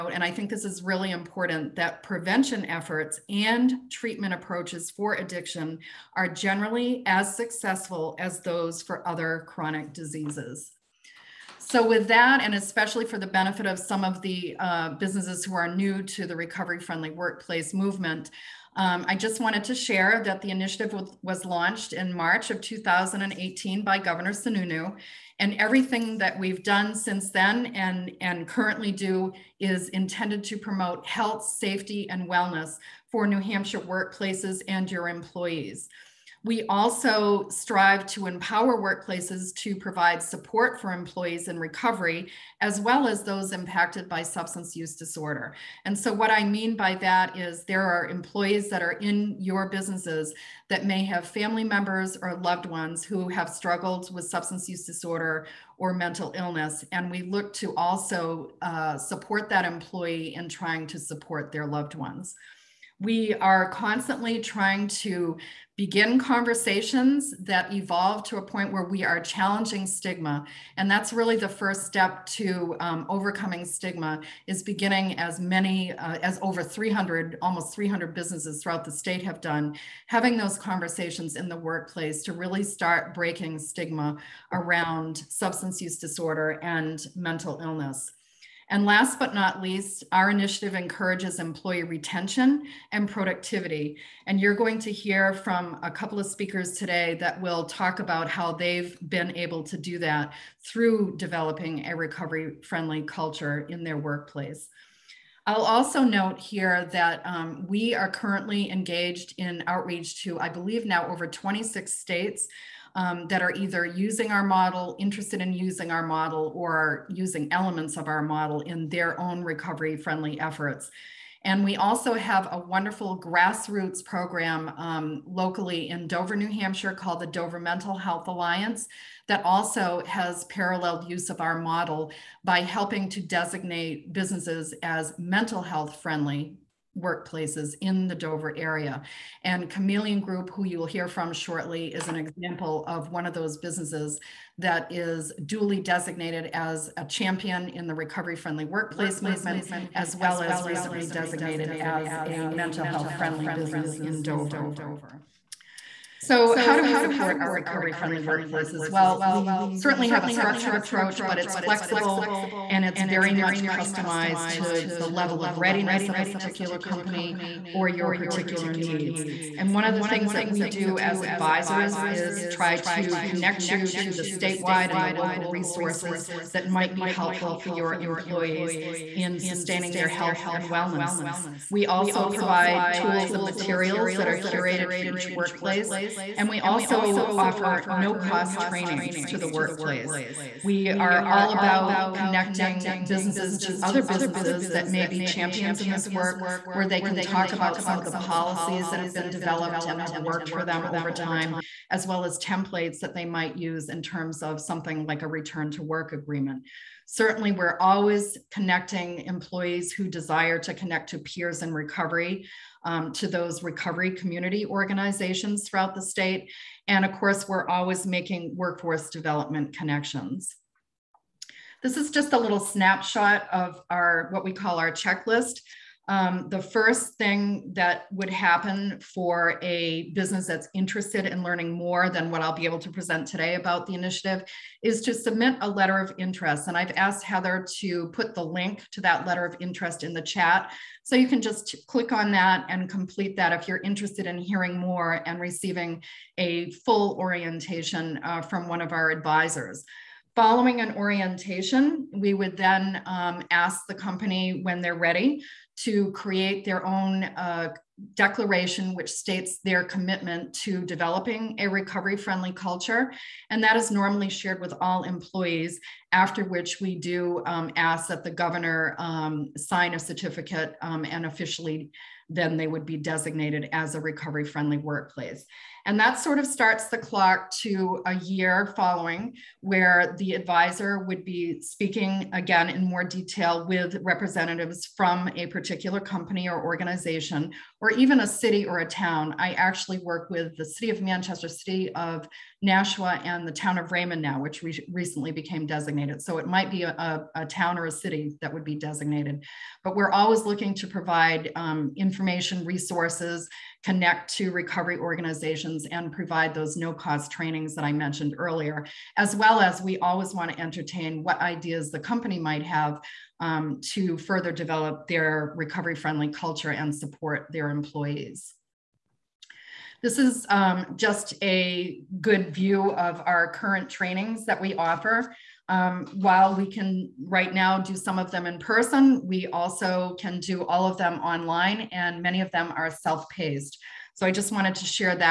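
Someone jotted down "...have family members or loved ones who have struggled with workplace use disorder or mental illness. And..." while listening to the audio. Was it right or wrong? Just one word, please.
wrong.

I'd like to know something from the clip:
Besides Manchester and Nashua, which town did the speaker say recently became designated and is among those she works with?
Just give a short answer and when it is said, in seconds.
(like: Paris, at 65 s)
Raymond, at 293 s.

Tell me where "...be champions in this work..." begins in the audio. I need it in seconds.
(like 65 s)
195 s.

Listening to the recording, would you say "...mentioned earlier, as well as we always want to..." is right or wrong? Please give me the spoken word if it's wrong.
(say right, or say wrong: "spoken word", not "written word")
right.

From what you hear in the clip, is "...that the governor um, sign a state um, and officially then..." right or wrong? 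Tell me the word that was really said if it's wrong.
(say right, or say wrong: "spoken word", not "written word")
wrong: "certificate", not "state".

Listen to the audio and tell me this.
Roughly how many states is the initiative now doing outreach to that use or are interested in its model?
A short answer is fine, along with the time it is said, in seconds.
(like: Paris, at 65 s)
26, at 111 s.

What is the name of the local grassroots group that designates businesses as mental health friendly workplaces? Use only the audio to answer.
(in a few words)
Dover Mental Health Alliance.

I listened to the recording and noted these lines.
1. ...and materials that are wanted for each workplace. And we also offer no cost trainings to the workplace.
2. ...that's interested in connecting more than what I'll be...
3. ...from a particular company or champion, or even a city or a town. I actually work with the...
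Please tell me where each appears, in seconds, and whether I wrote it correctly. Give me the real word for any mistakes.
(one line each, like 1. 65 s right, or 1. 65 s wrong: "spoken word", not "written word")
1. 183 s wrong: "curated", not "wanted"
2. 230 s wrong: "learning", not "connecting"
3. 284 s wrong: "organization", not "champion".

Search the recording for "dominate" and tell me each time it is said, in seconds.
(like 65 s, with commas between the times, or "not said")
not said.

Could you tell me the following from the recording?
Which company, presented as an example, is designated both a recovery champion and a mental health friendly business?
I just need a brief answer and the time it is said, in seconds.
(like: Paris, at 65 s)
Chameleon Group, at 139 s.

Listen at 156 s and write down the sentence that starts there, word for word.
So how do we support our recovery friendly workplaces?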